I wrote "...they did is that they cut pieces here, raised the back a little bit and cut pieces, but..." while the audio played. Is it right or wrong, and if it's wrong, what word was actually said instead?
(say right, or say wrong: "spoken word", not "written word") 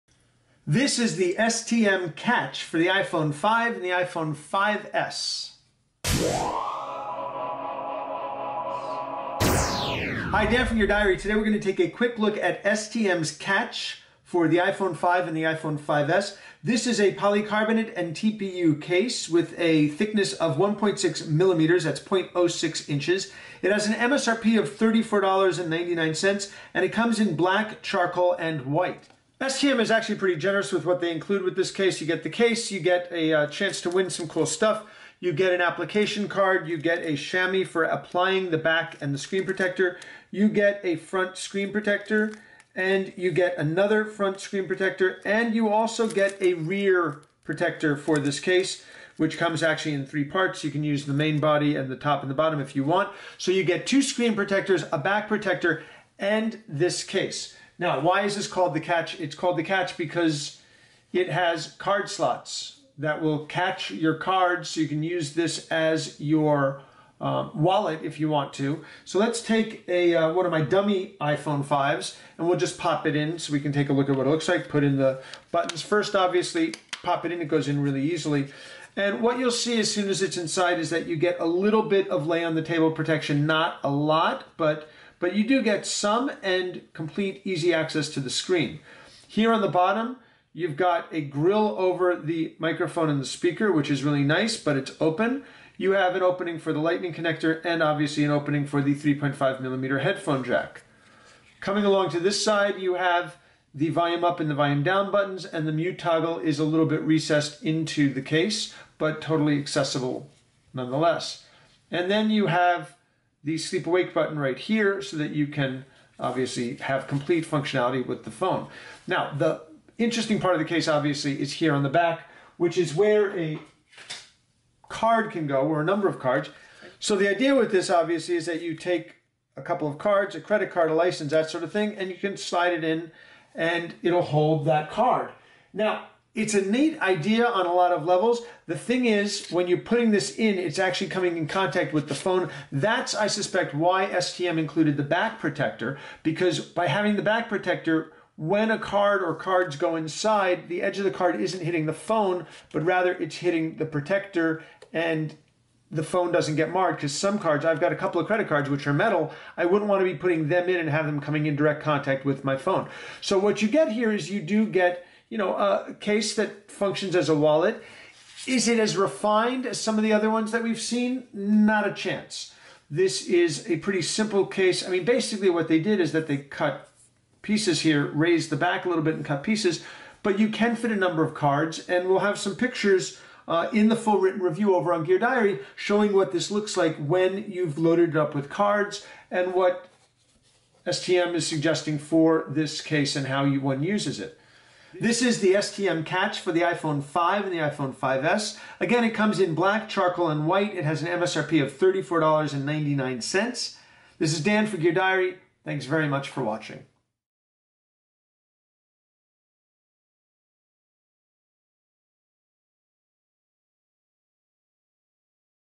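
right.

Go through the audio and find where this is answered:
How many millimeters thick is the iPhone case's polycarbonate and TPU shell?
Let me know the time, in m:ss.
0:20.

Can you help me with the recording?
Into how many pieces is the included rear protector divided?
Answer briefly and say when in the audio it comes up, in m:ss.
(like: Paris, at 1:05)
3, at 0:50.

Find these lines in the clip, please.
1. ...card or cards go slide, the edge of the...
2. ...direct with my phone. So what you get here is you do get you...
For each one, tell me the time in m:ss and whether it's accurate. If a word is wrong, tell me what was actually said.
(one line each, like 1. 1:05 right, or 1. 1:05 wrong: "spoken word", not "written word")
1. 2:28 wrong: "inside", not "slide"
2. 2:41 wrong: "contact", not "direct".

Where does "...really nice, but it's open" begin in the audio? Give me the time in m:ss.
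1:34.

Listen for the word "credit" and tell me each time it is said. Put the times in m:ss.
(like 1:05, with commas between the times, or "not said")
2:10, 2:38.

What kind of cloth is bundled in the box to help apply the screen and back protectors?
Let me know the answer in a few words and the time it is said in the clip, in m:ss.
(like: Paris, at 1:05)
A chamois, at 0:37.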